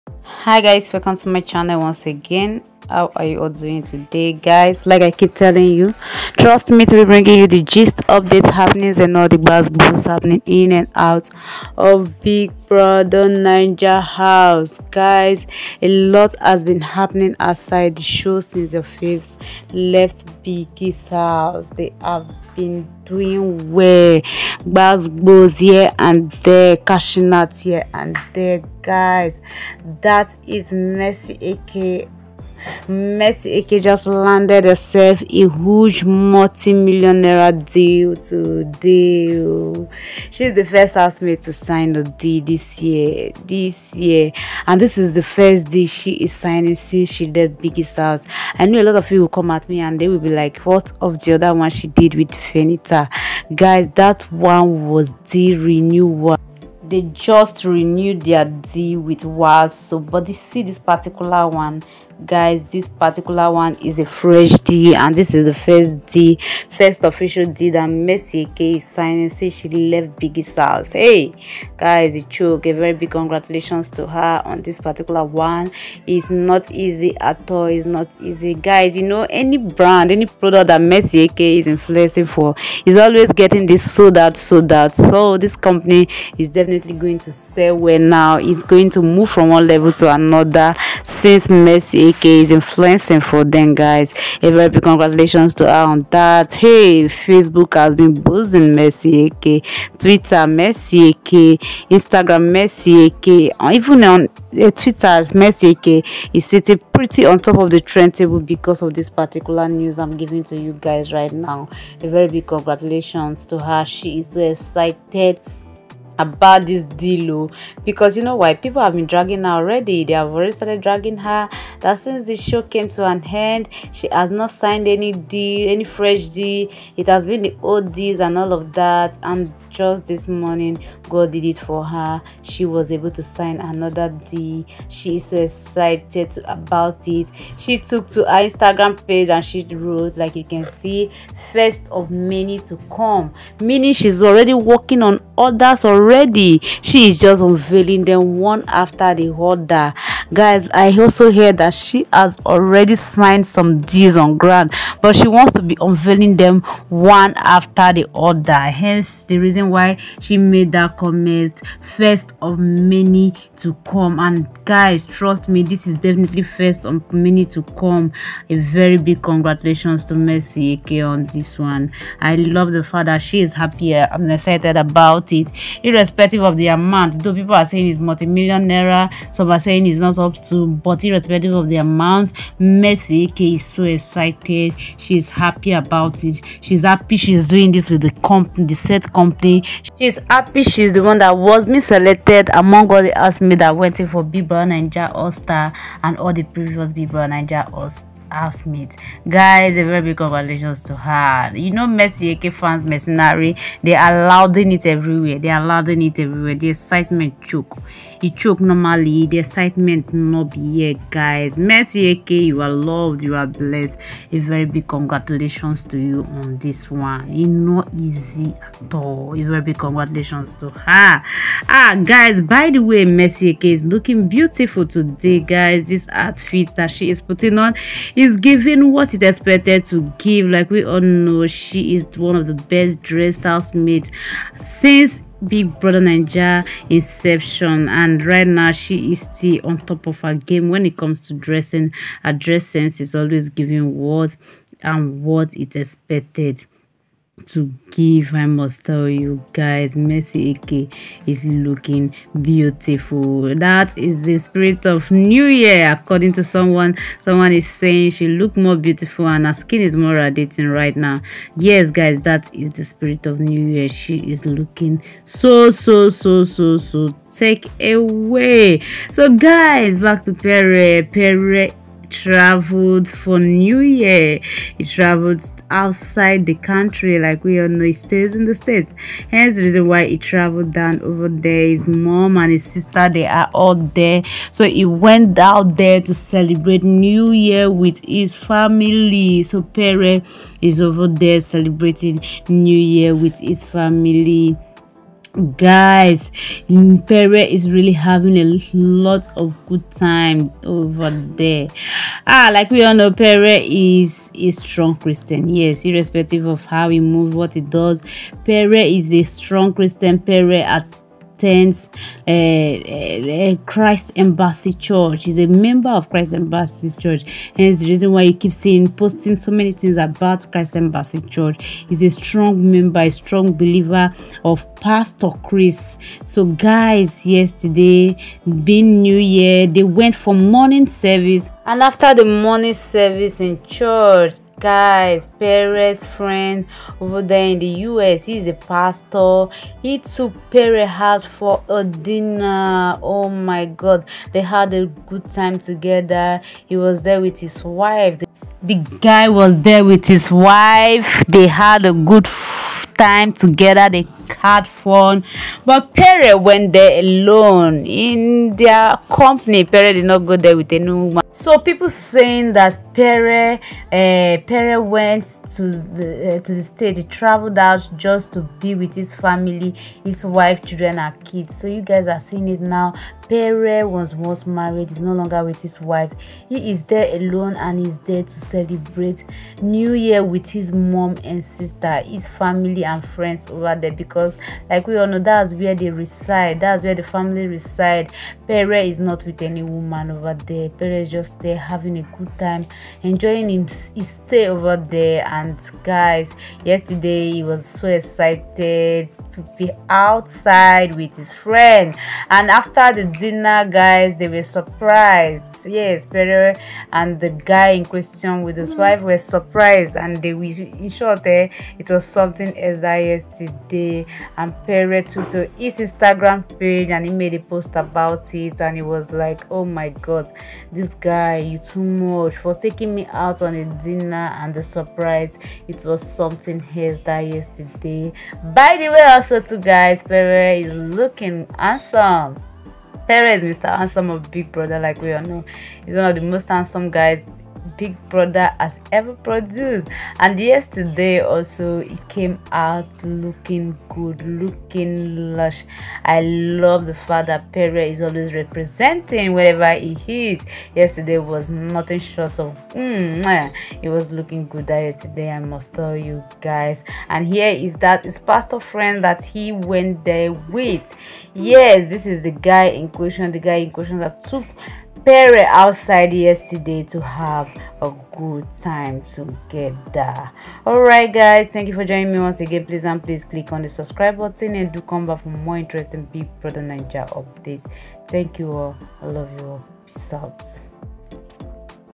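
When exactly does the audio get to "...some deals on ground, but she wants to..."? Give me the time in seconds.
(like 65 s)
153 s.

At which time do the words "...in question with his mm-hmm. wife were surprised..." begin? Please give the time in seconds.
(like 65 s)
407 s.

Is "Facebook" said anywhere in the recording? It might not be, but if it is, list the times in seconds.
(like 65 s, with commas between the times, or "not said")
97 s.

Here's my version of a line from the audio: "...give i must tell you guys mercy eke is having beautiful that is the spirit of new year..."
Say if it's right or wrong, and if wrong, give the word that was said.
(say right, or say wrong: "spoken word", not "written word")
wrong: "looking", not "having".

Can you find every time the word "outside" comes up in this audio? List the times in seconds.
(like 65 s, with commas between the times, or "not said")
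17 s, 275 s, 399 s, 465 s.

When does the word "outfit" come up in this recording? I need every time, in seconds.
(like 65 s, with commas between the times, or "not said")
226 s.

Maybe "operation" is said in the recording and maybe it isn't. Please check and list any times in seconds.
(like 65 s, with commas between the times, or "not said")
not said.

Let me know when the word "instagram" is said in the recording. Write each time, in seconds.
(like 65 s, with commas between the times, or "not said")
101 s, 138 s, 415 s.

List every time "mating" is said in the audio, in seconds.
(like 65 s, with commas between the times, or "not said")
not said.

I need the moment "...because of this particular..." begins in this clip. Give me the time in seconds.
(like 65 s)
108 s.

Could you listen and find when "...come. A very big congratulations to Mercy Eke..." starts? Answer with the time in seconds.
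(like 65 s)
167 s.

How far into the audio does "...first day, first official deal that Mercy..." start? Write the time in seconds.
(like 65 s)
65 s.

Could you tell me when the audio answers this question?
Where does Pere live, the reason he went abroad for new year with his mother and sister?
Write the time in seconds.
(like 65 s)
278 s.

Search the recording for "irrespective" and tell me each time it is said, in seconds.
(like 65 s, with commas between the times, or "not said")
176 s, 181 s, 305 s.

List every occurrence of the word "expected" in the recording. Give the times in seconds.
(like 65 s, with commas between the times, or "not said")
229 s, 245 s.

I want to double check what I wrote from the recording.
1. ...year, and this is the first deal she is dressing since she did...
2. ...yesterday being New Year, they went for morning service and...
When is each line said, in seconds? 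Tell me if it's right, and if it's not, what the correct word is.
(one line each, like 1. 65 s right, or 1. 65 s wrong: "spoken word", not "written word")
1. 43 s wrong: "signing", not "dressing"
2. 327 s right.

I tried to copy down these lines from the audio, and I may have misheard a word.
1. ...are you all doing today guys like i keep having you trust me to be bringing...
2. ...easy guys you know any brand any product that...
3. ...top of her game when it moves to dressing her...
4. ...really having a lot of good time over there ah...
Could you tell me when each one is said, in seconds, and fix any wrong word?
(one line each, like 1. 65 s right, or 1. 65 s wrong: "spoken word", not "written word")
1. 3 s wrong: "telling", not "having"
2. 78 s right
3. 239 s wrong: "comes", not "moves"
4. 297 s right.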